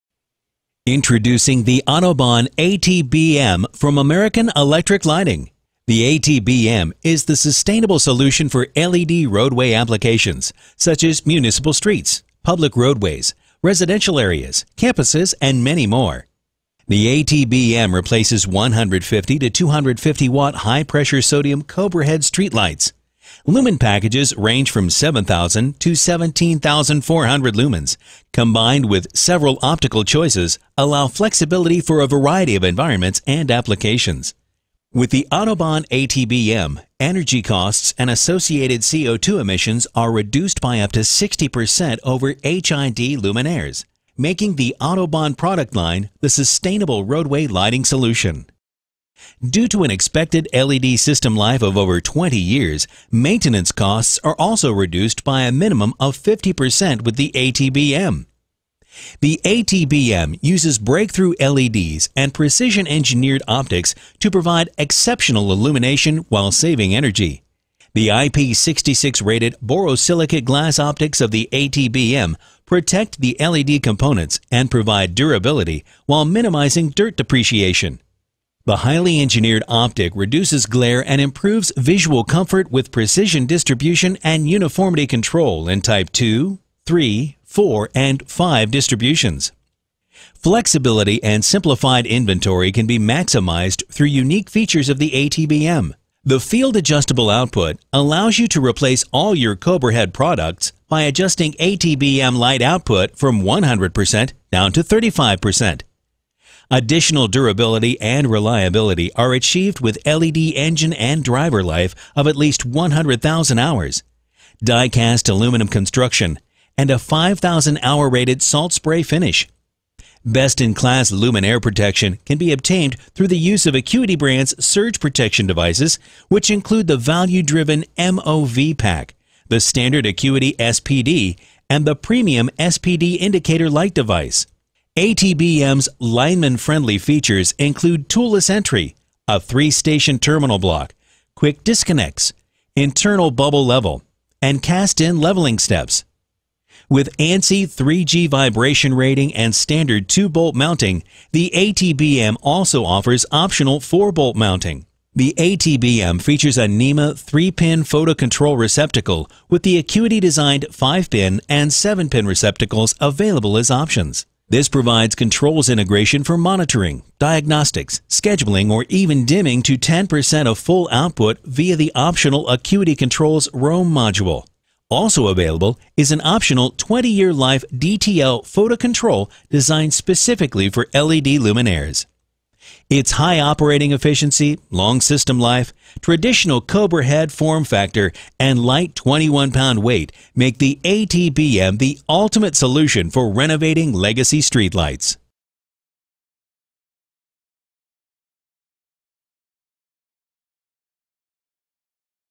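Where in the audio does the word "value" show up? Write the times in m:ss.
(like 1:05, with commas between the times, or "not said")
2:06.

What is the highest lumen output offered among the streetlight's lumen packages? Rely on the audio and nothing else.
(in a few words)
17,400.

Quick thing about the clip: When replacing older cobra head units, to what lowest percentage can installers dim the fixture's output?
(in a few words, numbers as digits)
35%.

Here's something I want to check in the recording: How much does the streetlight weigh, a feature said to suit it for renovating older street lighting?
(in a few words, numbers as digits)
21 pounds.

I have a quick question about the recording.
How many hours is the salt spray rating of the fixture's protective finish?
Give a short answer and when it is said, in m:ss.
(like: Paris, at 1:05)
5,000, at 1:56.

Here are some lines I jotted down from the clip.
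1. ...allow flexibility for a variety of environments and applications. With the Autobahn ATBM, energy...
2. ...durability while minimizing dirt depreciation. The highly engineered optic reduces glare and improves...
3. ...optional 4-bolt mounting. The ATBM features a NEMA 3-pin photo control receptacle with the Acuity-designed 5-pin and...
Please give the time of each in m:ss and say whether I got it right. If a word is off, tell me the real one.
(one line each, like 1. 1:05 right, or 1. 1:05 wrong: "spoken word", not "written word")
1. 0:30 right
2. 1:15 right
3. 2:33 right.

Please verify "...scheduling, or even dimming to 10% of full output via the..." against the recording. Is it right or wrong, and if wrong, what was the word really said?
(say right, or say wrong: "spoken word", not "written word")
right.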